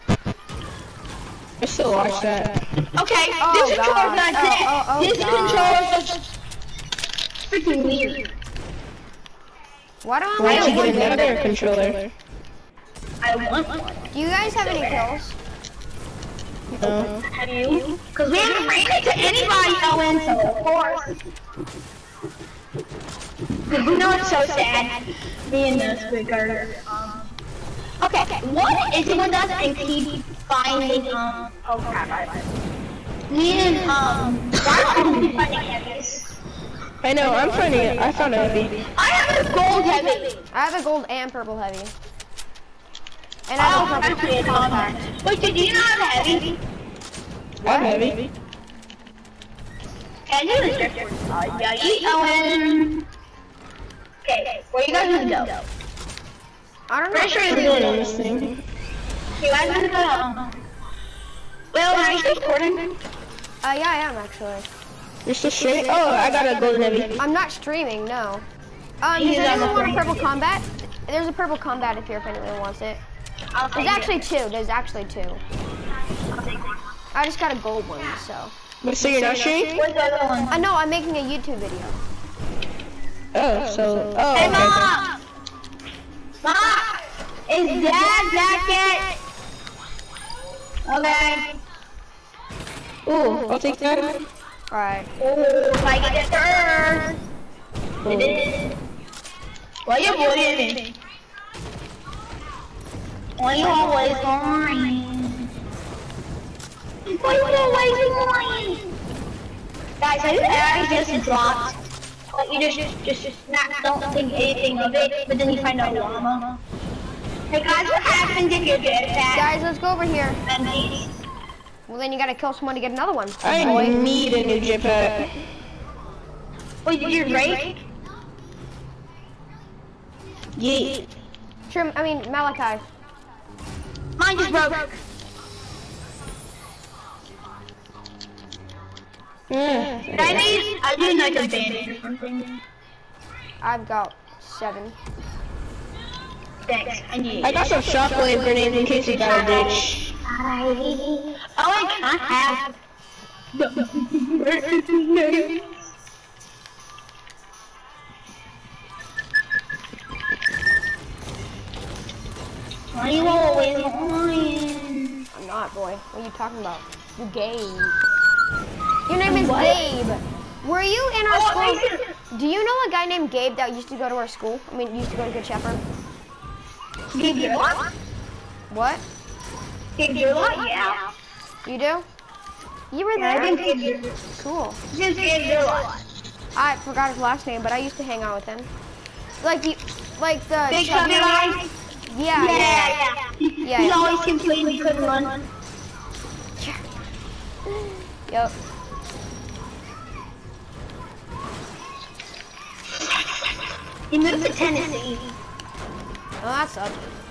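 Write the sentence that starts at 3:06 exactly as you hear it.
I forgot his last name, but I used to hang out with him.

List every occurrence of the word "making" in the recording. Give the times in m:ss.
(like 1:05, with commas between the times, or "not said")
1:20.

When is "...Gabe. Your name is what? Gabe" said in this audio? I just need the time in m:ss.
2:47.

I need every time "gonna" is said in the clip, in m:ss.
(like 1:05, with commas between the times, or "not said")
0:55, 0:59.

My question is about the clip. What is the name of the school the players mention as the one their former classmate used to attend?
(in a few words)
Good Shepherd.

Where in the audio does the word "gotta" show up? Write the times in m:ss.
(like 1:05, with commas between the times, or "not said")
1:06, 2:02.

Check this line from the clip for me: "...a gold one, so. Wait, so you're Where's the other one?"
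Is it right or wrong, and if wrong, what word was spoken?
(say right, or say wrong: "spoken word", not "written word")
right.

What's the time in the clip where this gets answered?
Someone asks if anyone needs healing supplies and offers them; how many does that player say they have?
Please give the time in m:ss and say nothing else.
2:24.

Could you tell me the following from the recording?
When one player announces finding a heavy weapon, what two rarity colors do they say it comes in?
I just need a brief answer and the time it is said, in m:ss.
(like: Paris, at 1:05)
gold and purple, at 0:40.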